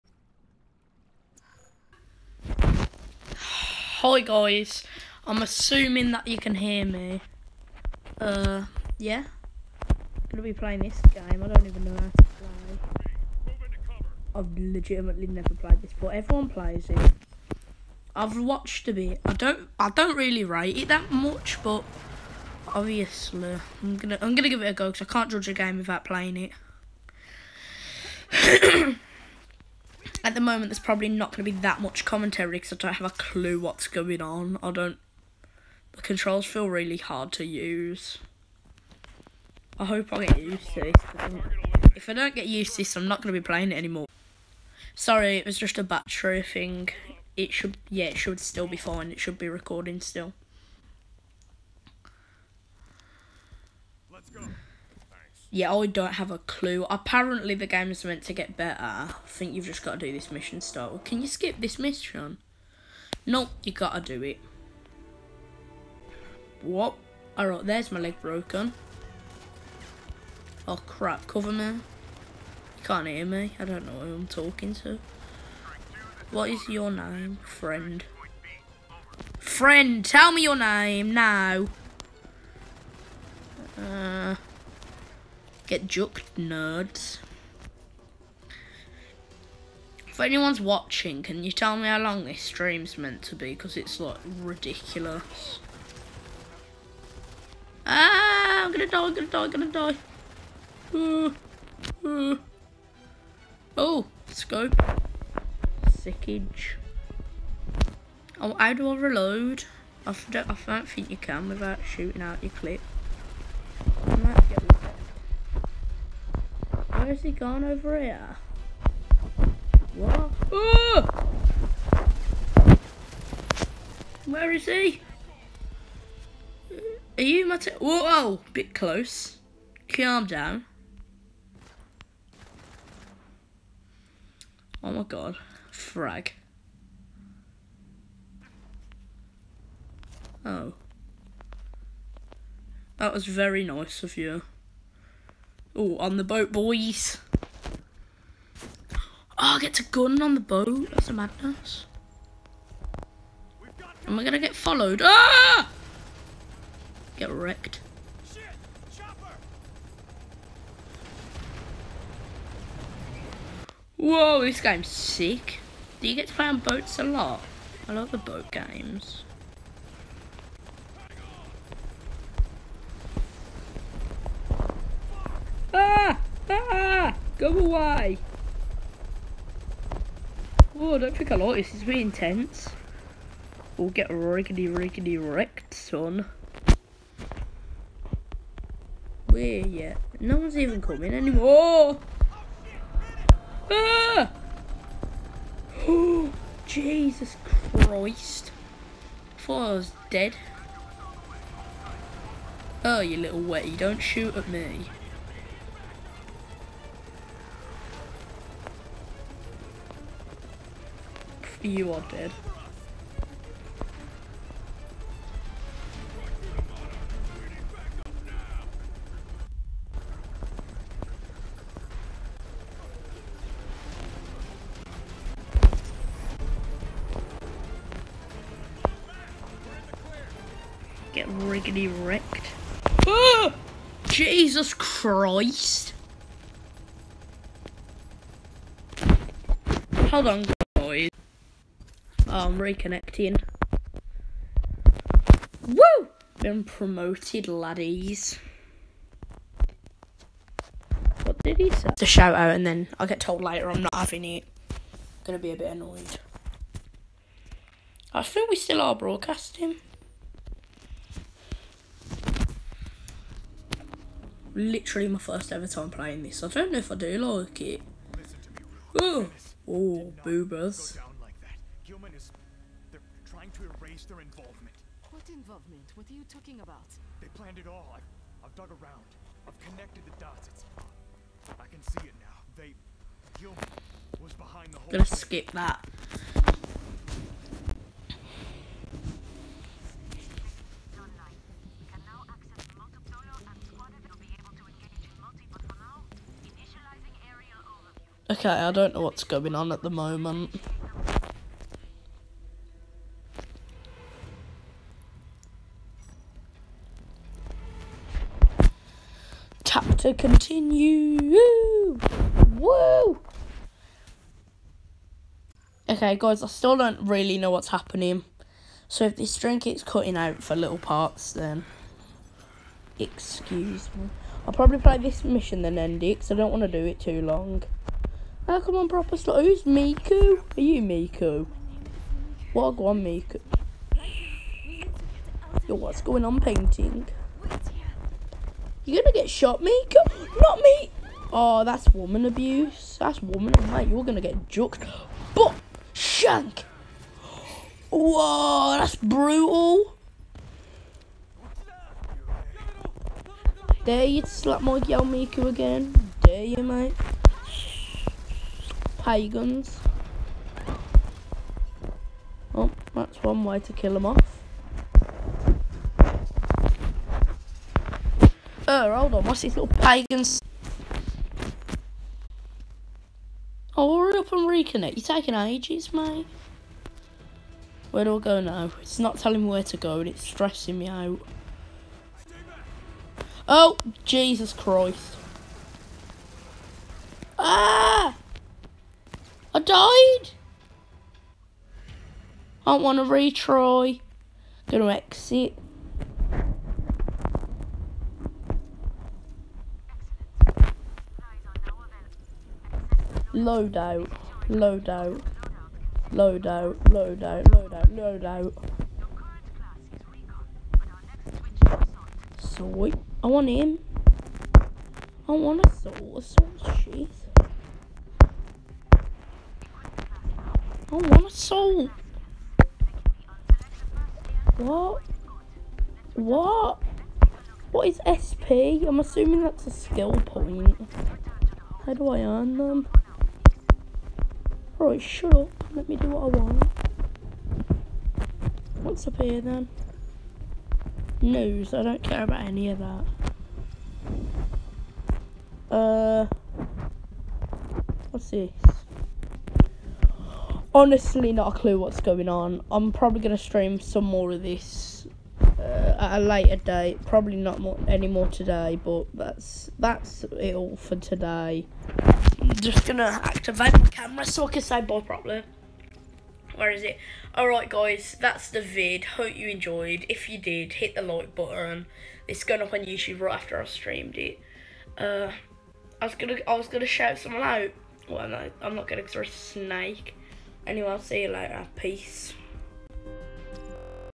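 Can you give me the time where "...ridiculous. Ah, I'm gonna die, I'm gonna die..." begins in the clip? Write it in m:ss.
1:34.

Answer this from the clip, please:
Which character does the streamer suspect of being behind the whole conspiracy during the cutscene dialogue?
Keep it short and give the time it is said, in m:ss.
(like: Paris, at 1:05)
Gilman, at 4:43.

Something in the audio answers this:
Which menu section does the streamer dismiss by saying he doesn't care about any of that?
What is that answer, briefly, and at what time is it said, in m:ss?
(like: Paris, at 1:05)
News, at 7:21.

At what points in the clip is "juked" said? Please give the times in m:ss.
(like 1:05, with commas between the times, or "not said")
1:25, 5:44.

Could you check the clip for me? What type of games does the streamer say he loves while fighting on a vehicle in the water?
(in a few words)
boat games.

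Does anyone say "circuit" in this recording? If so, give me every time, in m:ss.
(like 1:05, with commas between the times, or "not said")
not said.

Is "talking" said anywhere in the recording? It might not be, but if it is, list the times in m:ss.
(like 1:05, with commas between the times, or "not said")
1:14, 4:36.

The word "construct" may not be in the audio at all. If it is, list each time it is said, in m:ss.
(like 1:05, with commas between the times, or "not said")
not said.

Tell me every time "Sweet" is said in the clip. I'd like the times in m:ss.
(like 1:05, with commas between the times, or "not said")
6:52.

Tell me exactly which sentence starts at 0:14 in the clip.
I've legitimately never played this, but everyone plays it.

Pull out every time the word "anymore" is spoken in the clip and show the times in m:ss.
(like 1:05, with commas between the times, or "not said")
0:43, 3:11, 7:37.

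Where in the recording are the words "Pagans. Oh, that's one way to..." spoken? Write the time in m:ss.
5:58.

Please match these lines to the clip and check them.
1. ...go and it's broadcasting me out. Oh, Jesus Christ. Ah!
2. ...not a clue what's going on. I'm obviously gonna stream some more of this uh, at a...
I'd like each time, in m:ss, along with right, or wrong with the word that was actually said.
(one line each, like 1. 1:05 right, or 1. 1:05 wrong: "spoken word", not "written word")
1. 6:19 wrong: "stressing", not "broadcasting"
2. 7:31 wrong: "probably", not "obviously".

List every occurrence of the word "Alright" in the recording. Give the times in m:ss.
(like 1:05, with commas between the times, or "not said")
1:07, 7:14, 7:47.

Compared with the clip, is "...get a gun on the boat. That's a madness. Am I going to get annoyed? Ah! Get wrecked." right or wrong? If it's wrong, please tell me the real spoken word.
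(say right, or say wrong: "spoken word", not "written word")
wrong: "followed", not "annoyed".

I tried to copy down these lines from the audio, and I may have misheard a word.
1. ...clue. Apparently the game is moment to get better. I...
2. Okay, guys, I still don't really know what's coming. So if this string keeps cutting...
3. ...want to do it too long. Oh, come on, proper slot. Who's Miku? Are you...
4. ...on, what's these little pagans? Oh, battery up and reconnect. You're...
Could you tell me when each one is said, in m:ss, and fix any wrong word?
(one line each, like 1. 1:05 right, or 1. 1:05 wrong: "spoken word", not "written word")
1. 0:56 wrong: "meant", not "moment"
2. 5:15 wrong: "happening", not "coming"
3. 5:26 right
4. 6:09 wrong: "hurry", not "battery".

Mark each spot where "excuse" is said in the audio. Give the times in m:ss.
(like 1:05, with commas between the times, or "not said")
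5:22.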